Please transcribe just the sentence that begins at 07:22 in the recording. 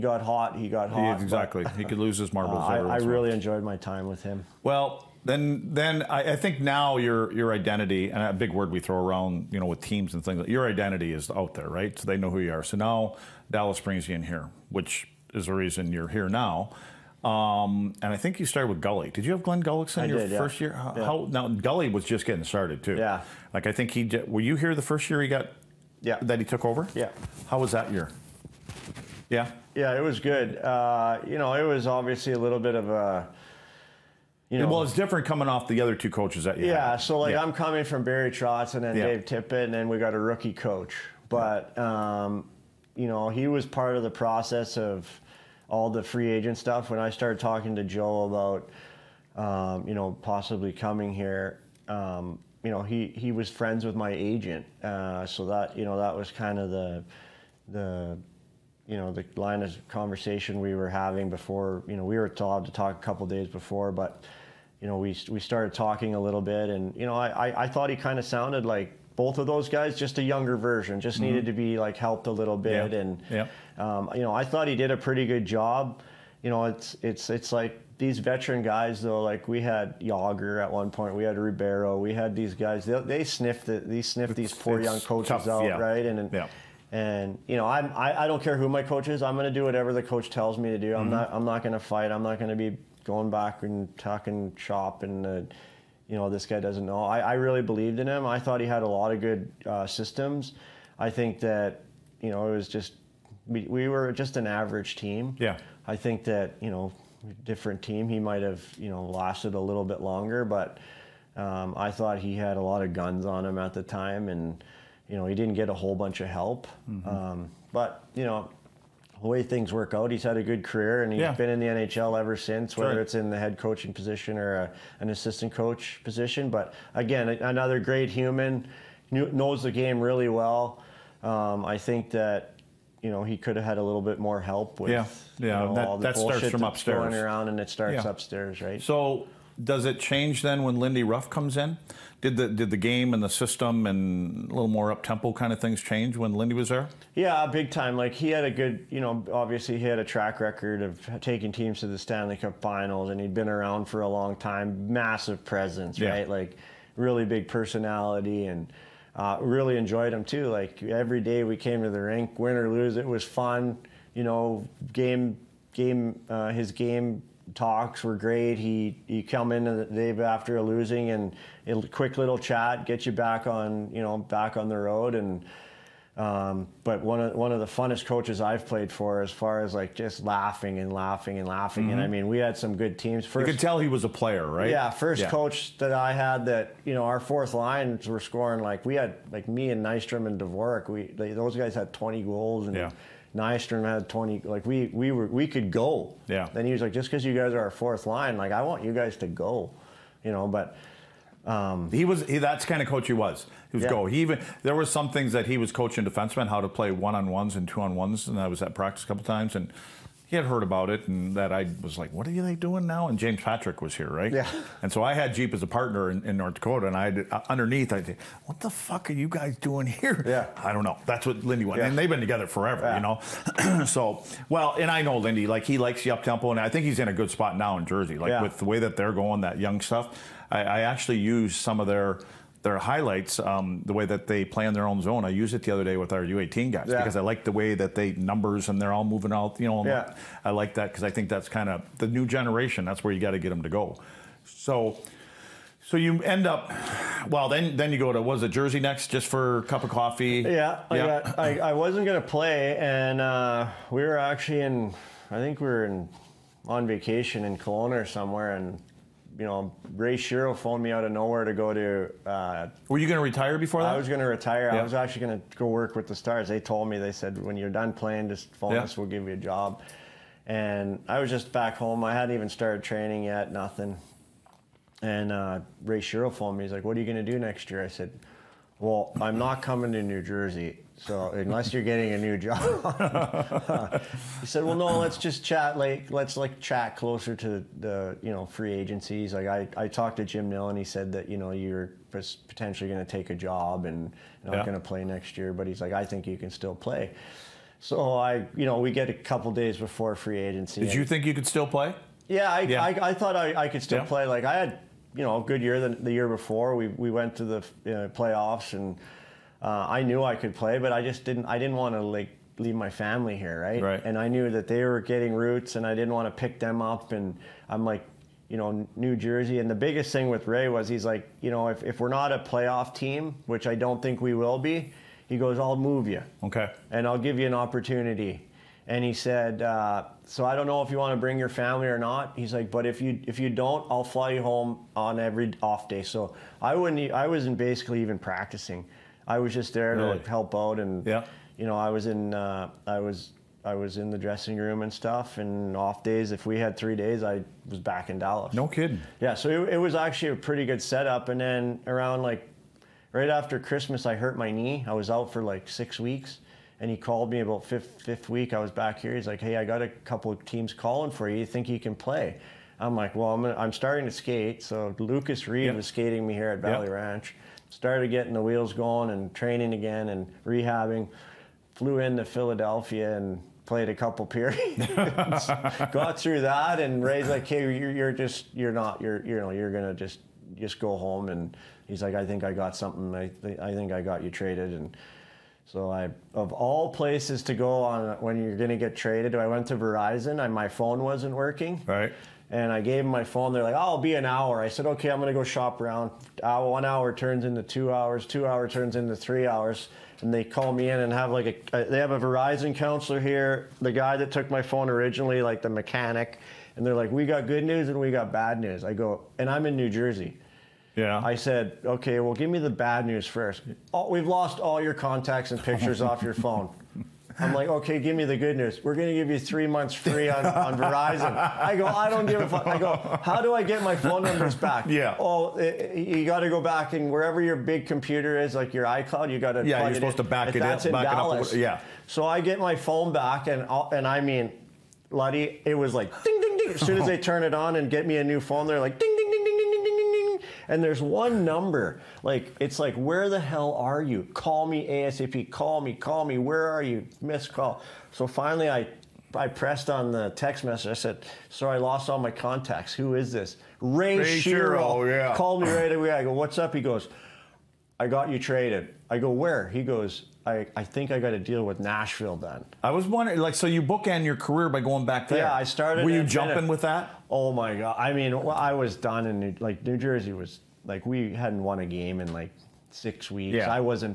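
Like it's like, where the hell are you?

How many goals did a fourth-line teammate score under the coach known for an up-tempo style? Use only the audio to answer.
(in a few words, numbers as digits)
20.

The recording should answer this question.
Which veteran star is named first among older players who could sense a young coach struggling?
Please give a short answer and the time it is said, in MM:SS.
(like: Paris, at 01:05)
Jagr, at 01:19.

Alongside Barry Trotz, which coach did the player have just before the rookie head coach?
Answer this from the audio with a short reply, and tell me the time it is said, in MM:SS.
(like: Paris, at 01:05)
Dave Tippett, at 00:39.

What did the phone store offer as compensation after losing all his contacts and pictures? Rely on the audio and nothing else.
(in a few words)
3 months free.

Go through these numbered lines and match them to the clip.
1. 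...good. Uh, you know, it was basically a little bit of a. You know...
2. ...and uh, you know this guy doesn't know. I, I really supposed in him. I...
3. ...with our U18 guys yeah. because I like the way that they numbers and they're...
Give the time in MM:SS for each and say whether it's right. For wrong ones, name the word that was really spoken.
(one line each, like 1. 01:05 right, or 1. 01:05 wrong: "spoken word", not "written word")
1. 00:30 wrong: "obviously", not "basically"
2. 01:35 wrong: "believed", not "supposed"
3. 03:55 right.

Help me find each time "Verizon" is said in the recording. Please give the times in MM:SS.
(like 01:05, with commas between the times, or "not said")
06:29, 06:42, 07:00.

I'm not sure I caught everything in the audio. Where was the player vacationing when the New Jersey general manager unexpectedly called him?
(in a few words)
Kelowna.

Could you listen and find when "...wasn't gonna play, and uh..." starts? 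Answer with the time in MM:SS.
04:11.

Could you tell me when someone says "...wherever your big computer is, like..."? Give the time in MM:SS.
07:07.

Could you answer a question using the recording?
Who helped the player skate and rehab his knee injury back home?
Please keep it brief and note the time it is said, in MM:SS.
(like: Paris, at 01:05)
Lucas Reed, at 06:04.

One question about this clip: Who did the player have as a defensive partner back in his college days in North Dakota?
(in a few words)
Jeep.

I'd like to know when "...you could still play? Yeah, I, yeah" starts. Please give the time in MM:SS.
05:01.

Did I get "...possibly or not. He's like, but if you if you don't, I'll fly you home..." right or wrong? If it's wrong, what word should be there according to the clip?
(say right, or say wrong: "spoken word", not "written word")
wrong: "family", not "possibly".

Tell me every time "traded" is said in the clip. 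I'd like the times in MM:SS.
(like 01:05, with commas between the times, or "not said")
06:24, 06:28, 07:38.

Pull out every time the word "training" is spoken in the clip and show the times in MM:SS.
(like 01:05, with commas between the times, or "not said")
04:32, 06:09.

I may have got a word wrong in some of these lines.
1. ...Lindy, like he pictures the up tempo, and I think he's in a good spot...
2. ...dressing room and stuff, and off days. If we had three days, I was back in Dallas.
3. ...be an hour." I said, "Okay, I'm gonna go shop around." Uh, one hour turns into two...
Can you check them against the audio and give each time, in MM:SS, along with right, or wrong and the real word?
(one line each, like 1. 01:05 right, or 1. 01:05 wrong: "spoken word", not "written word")
1. 03:45 wrong: "likes", not "pictures"
2. 05:44 right
3. 06:33 right.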